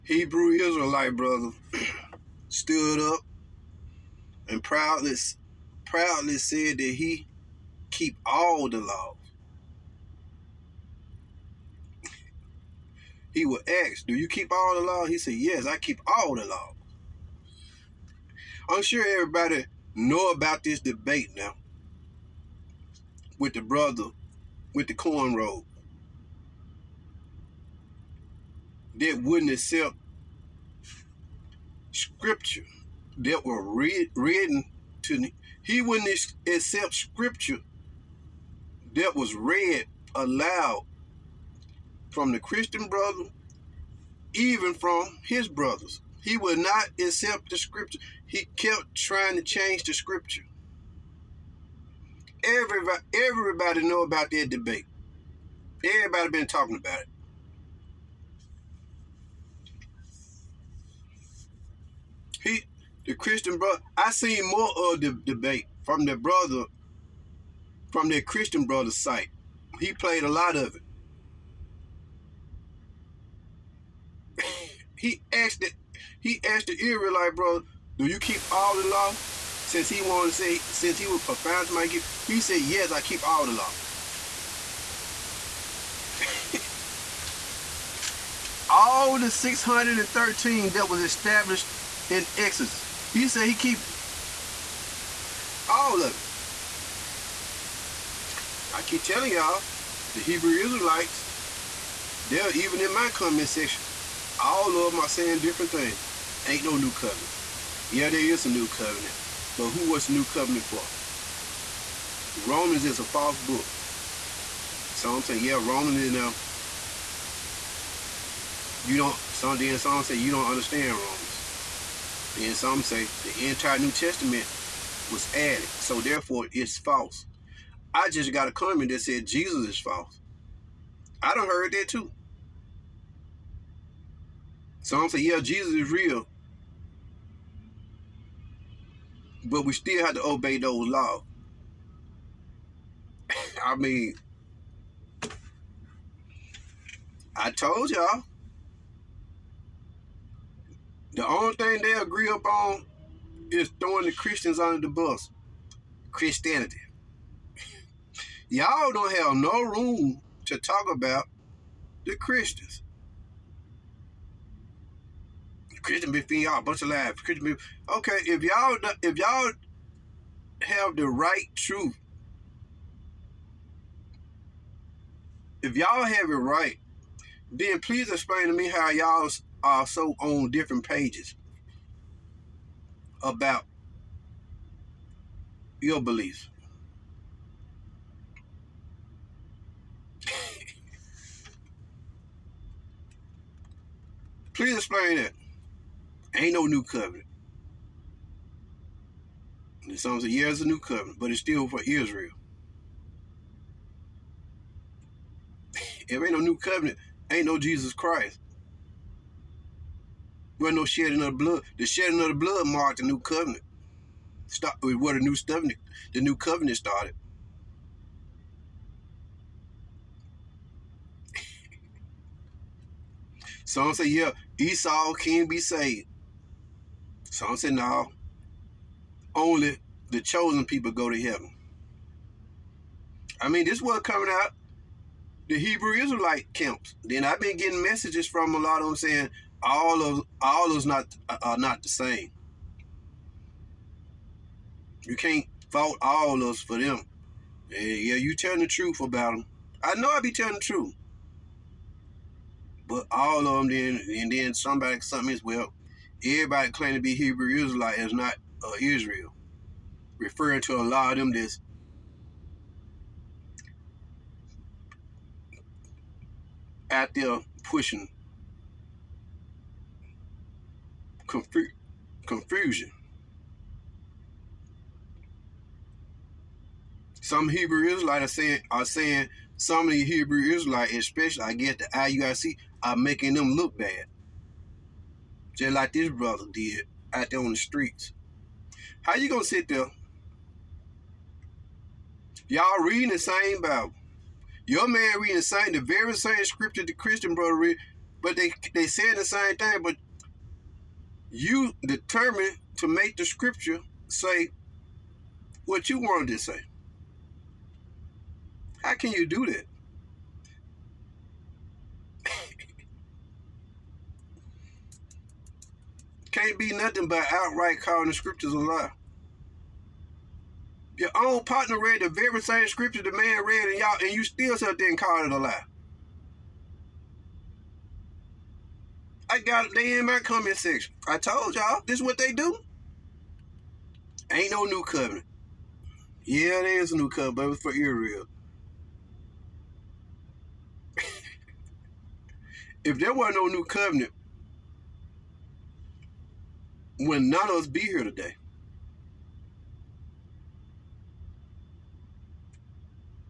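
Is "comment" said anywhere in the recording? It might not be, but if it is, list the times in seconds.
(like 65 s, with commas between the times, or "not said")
103 s, 128 s, 330 s.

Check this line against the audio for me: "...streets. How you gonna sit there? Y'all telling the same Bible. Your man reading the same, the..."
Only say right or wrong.
wrong.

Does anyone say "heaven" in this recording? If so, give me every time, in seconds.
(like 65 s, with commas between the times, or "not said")
231 s.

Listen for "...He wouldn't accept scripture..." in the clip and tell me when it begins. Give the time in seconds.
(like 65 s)
35 s.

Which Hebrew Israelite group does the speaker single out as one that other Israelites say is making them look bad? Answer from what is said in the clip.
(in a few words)
IUIC.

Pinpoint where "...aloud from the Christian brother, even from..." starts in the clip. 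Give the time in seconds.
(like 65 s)
40 s.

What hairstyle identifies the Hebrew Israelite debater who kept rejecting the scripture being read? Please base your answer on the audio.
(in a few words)
cornrow.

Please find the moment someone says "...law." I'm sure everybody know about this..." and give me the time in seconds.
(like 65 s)
16 s.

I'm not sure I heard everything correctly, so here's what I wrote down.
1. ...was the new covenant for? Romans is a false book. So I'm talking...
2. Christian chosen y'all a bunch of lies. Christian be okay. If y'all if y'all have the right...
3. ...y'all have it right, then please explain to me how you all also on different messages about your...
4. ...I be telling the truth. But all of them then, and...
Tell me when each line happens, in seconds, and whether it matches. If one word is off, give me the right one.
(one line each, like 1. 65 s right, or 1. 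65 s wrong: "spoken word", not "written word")
1. 109 s wrong: "saying", not "talking"
2. 165 s wrong: "between", not "chosen"
3. 175 s wrong: "pages", not "messages"
4. 250 s right.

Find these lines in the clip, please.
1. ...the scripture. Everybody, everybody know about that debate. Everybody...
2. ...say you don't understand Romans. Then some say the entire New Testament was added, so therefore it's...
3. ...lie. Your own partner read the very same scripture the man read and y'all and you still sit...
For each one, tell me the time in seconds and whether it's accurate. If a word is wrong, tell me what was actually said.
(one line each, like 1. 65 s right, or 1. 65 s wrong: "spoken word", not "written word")
1. 49 s right
2. 120 s right
3. 318 s right.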